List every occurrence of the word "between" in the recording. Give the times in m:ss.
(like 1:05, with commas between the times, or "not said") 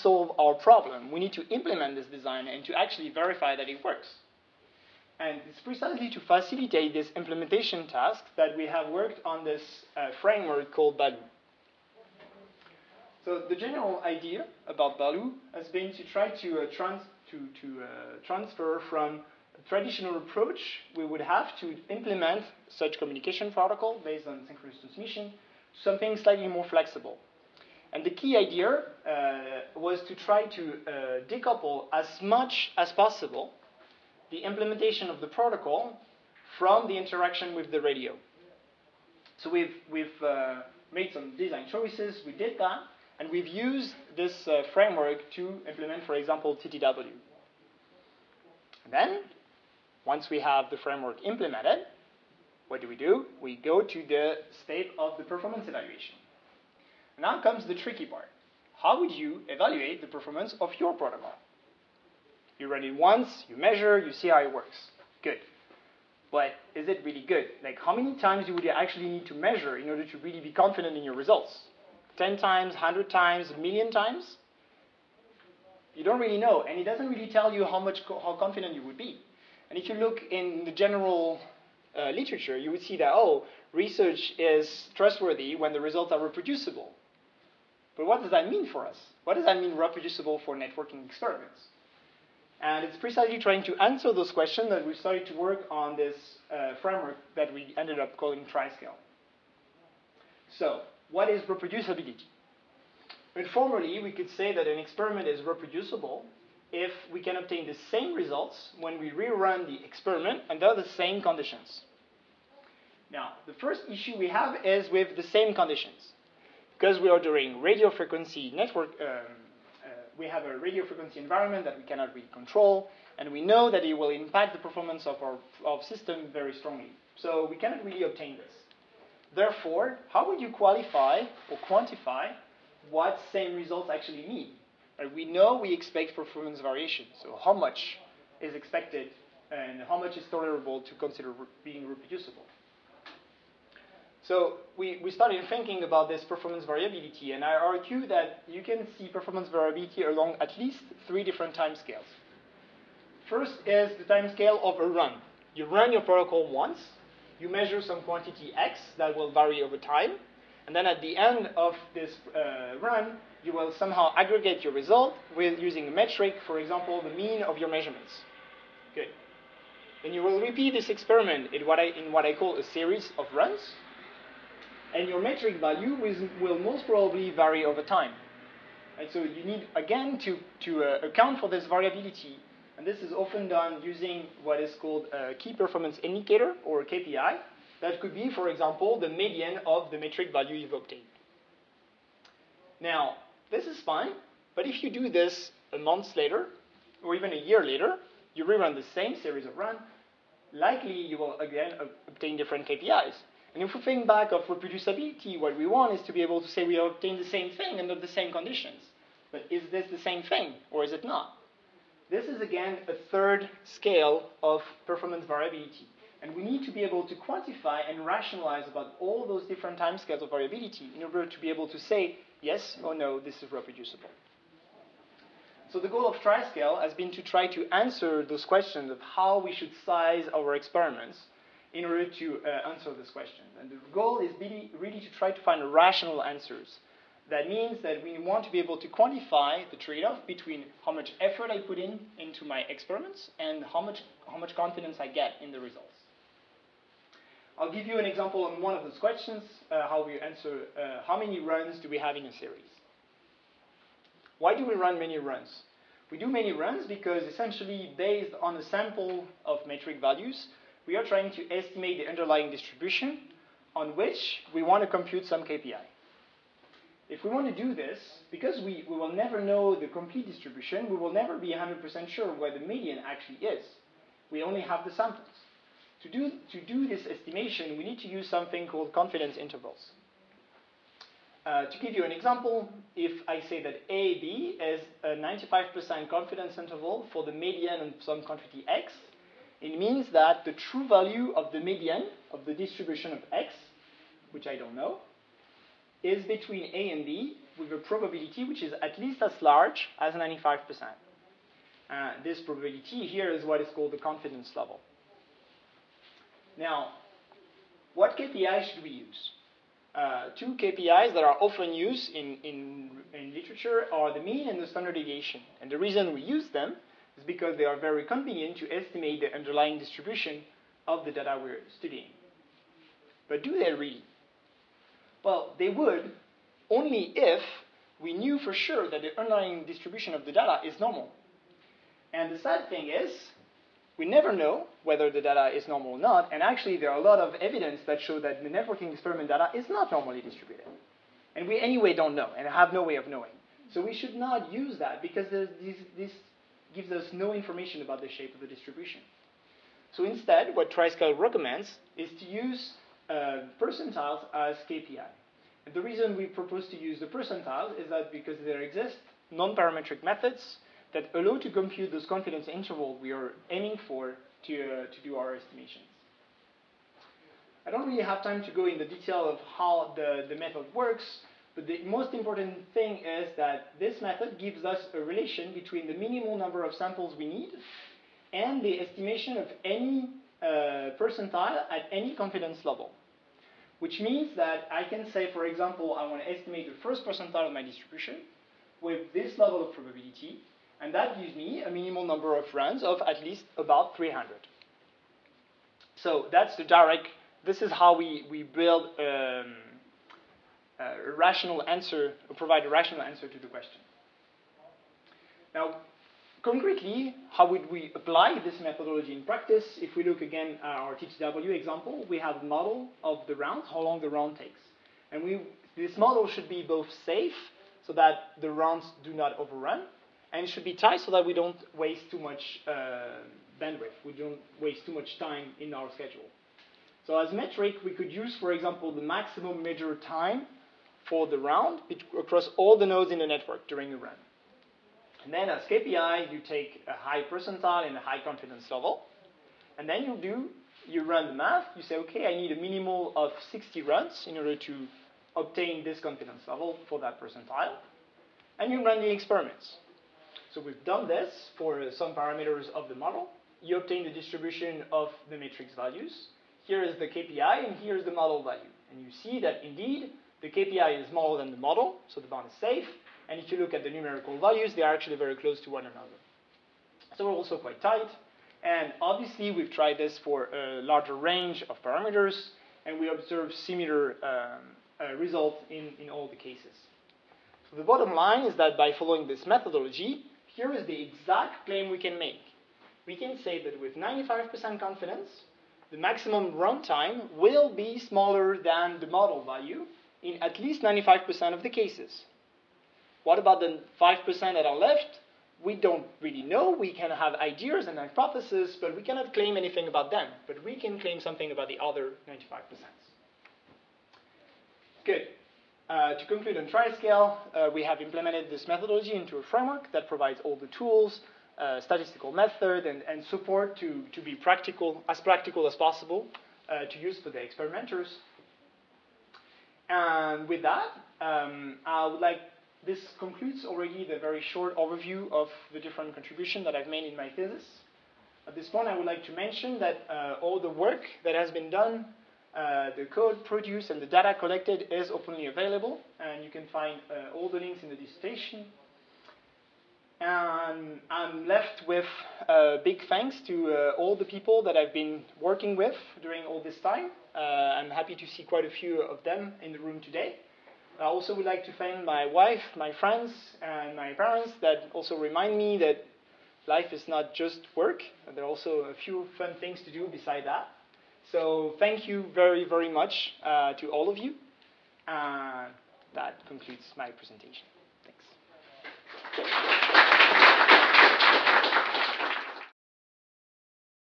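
4:00, 4:56, 6:15.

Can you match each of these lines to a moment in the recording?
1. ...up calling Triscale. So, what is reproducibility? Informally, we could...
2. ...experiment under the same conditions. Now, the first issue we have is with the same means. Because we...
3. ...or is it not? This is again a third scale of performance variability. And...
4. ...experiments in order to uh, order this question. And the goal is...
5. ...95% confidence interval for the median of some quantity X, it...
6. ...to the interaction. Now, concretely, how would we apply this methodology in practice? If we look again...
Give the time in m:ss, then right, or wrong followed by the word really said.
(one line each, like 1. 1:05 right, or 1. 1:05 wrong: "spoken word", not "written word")
1. 1:37 right
2. 1:49 wrong: "conditions", not "means"
3. 3:30 right
4. 3:50 wrong: "answer", not "order"
5. 4:45 right
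6. 6:43 wrong: "question", not "interaction".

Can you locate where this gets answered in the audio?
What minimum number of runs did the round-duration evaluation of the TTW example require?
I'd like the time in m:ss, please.
7:23.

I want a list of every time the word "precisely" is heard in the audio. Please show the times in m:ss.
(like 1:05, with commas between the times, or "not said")
0:05, 1:32.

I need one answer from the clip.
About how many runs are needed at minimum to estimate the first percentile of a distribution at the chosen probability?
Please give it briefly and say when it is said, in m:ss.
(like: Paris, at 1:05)
300, at 6:33.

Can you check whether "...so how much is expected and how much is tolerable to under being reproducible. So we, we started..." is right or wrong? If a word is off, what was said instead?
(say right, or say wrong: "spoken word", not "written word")
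wrong: "consider", not "under".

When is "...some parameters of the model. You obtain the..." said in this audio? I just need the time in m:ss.
7:31.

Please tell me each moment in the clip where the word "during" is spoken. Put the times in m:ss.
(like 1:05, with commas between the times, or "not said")
7:13, 9:06.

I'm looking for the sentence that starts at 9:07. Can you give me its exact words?
Uh, I'm happy to see quite a few of them in the room today.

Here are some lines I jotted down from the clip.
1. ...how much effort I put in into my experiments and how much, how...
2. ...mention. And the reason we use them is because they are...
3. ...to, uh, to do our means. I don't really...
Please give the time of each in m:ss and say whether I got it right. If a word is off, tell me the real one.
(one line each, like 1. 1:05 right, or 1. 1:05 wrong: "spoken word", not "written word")
1. 4:00 right
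2. 5:14 wrong: "deviation", not "mention"
3. 6:04 wrong: "estimations", not "means".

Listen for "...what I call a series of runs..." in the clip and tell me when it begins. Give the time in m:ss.
2:52.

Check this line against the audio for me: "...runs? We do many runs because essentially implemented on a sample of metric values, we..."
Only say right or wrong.
wrong.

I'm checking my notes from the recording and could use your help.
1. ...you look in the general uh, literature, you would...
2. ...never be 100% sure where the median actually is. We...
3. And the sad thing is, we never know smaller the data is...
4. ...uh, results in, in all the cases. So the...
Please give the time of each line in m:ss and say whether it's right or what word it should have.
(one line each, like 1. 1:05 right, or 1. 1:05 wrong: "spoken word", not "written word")
1. 1:19 right
2. 4:31 right
3. 5:32 wrong: "whether", not "smaller"
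4. 7:54 right.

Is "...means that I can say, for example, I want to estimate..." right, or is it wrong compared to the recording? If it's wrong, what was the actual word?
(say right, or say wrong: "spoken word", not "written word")
right.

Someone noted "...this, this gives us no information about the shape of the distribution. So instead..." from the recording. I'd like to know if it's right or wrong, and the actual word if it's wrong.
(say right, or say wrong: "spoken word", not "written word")
right.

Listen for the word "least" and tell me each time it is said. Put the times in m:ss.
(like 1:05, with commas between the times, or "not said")
2:30, 4:58, 6:33, 8:10.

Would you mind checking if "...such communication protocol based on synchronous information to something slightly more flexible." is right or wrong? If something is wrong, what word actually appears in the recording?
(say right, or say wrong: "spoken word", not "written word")
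wrong: "transmission", not "information".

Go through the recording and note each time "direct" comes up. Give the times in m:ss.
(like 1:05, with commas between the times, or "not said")
6:36.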